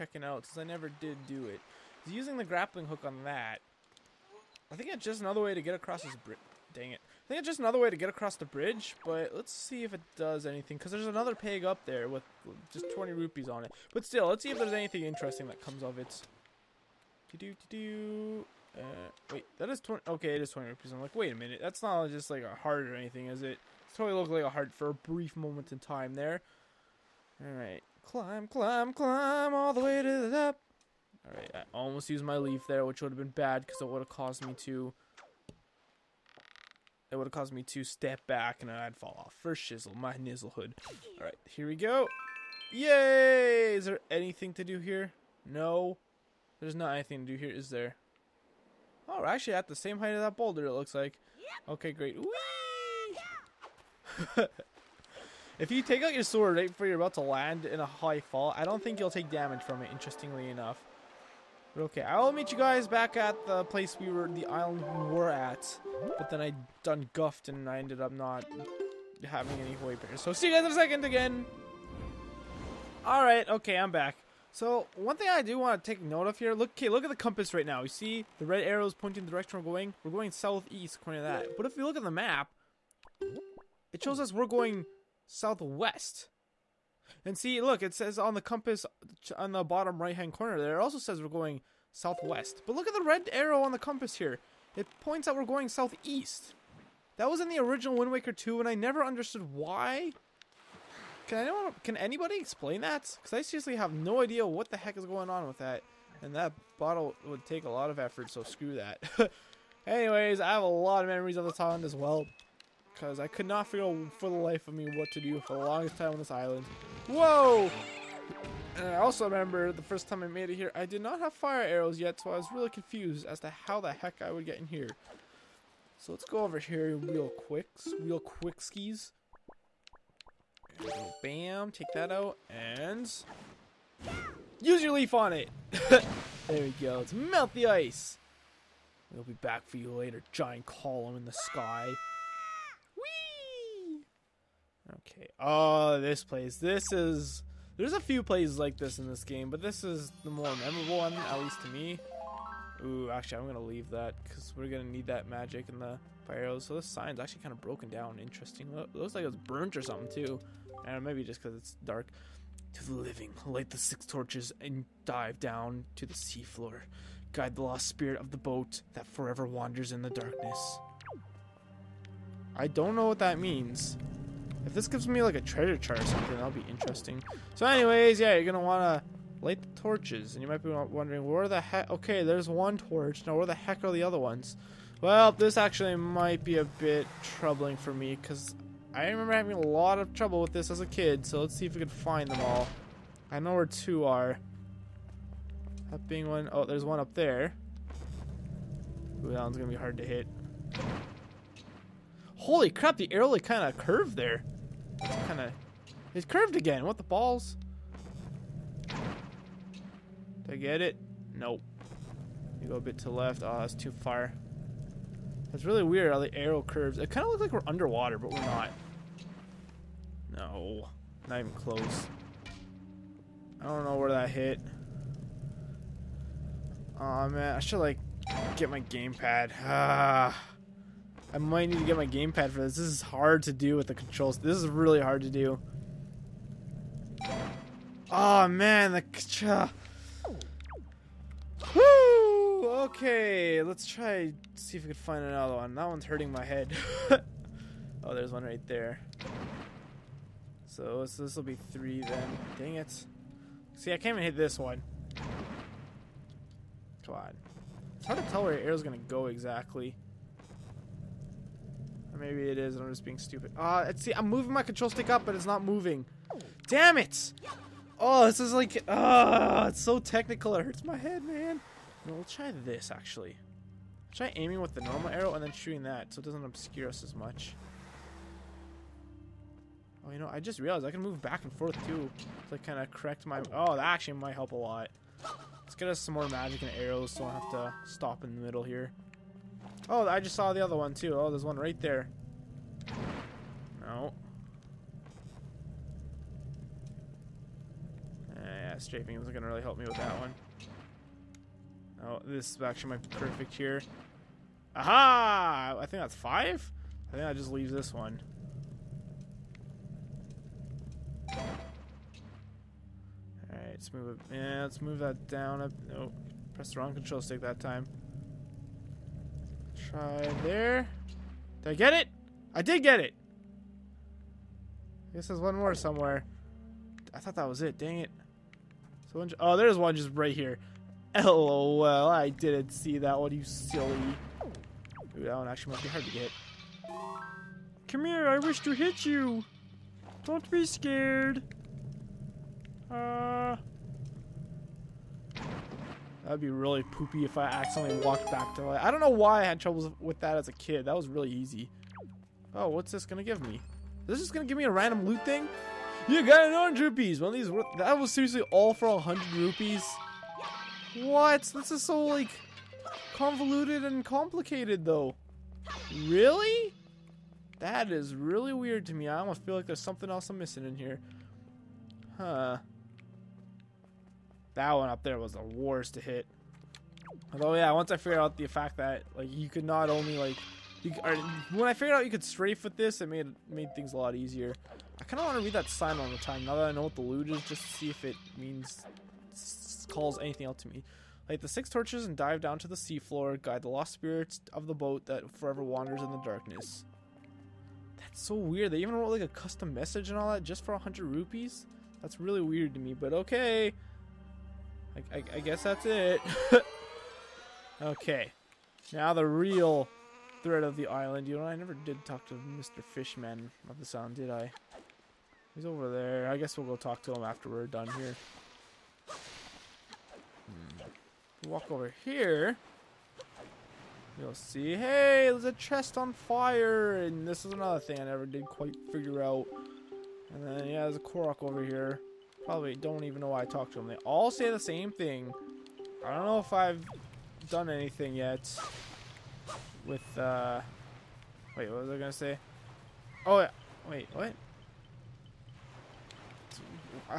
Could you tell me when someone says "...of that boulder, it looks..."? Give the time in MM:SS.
00:50.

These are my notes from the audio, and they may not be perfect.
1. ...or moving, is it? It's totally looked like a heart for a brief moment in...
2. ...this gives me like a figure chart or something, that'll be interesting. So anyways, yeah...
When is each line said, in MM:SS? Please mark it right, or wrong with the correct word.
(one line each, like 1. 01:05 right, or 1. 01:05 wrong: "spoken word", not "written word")
1. 00:22 wrong: "anything", not "moving"
2. 02:54 wrong: "treasure", not "figure".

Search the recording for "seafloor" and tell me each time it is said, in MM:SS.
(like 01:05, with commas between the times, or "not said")
02:46, 06:32.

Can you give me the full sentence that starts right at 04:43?
Oh, that actually might help a lot.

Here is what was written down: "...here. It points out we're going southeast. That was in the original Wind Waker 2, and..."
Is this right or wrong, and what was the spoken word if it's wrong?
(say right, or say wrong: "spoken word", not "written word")
right.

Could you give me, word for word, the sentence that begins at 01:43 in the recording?
Because I seriously have no idea what the heck is going on with that.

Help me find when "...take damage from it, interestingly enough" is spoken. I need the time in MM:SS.
00:59.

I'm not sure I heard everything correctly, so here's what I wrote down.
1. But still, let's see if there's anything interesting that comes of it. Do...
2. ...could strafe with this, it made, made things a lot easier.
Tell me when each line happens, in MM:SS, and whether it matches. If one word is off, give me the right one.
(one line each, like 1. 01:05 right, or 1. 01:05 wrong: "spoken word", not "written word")
1. 00:13 right
2. 06:22 right.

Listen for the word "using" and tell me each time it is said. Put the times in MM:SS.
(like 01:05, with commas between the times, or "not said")
00:02.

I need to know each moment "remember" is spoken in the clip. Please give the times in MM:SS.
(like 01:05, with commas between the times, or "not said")
01:59, 03:09.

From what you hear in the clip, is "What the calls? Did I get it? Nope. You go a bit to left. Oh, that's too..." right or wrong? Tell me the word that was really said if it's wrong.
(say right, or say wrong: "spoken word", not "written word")
wrong: "balls", not "calls".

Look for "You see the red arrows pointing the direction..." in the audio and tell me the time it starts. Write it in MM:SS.
01:17.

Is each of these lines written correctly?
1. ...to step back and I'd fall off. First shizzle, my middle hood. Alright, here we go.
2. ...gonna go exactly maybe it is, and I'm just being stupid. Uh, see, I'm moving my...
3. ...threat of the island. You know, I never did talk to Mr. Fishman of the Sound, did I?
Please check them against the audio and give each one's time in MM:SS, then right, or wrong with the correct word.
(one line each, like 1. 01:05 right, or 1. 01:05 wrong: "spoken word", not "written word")
1. 00:37 wrong: "nizzle", not "middle"
2. 04:18 right
3. 06:50 right.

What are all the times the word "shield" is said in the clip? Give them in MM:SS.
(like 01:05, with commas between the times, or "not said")
not said.